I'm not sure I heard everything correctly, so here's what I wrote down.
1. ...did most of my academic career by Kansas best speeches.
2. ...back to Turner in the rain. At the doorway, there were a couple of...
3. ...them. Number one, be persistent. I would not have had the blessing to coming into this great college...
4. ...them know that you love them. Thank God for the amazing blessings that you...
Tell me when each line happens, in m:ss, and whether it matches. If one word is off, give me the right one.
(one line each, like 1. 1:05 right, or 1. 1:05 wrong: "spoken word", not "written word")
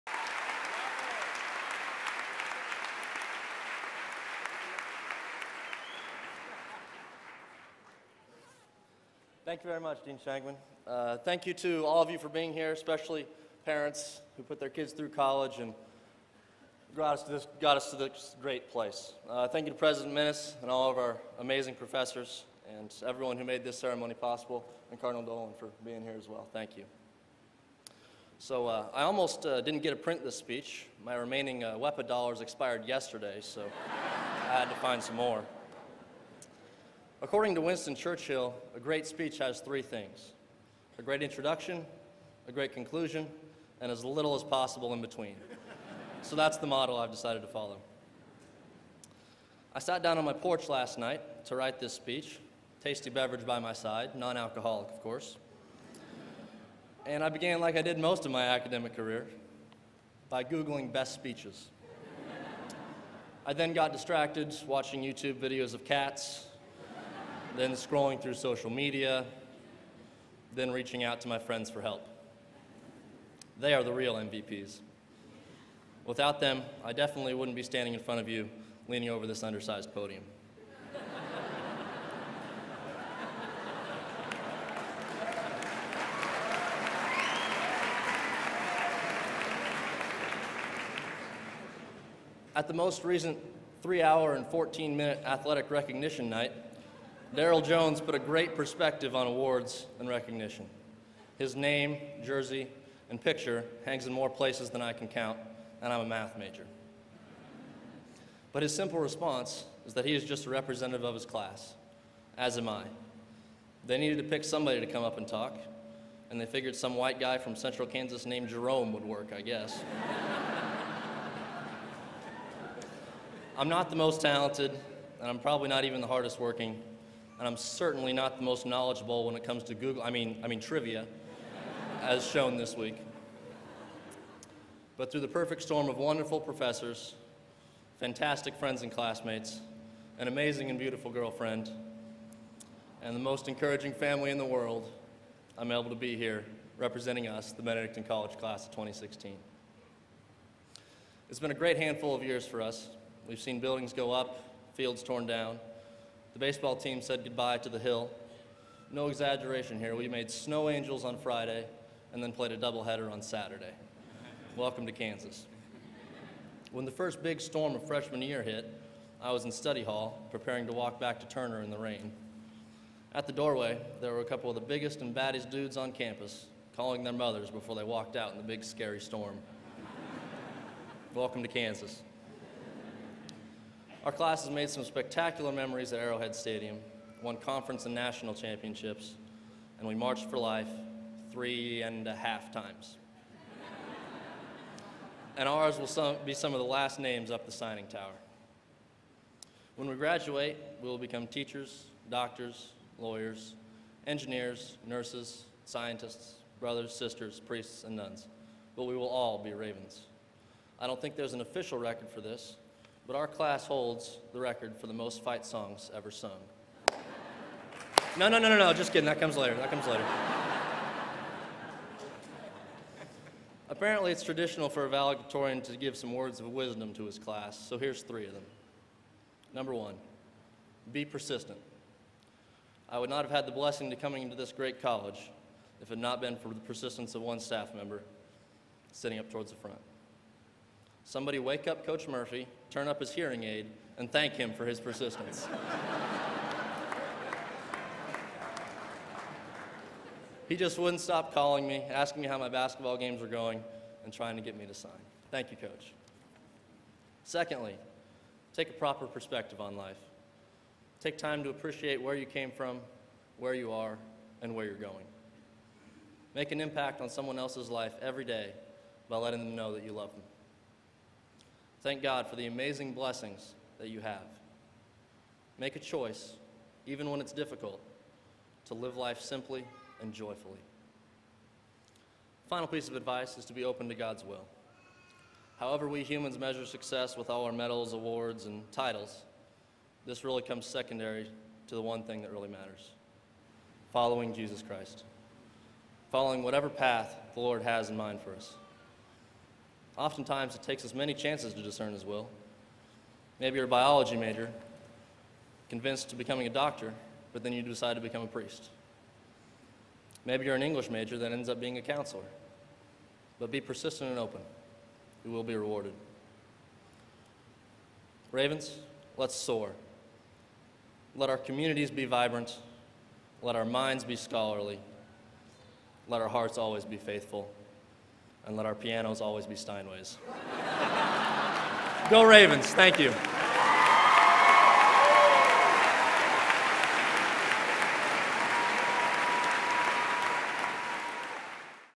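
1. 0:57 wrong: "Googling", not "Kansas"
2. 2:51 right
3. 3:48 right
4. 4:29 right.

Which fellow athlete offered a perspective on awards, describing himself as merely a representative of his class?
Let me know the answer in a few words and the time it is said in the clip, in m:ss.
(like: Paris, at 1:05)
Daryl Jones, at 1:37.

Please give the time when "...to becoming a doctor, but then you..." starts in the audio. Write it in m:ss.
5:06.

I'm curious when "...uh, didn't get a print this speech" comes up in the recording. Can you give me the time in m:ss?
0:29.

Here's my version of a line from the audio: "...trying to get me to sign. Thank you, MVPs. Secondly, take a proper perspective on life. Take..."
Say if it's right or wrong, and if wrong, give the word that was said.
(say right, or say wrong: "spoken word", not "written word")
wrong: "Coach", not "MVPs".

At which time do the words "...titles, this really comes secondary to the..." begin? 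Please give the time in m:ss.
4:48.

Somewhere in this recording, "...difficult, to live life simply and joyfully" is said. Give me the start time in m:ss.
4:37.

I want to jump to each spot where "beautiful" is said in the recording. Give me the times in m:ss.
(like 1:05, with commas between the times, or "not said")
2:20.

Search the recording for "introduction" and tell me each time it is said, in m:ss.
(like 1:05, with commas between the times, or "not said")
0:41.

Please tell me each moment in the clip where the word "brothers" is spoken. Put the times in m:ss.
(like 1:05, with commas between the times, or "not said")
3:26.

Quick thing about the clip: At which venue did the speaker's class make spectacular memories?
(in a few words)
Arrowhead Stadium.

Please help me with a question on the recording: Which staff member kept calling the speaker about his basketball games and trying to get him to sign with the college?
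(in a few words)
Coach Murphy.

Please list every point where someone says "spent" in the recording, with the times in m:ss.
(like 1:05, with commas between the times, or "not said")
not said.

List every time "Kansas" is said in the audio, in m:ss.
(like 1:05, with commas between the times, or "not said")
1:57, 2:44, 3:01.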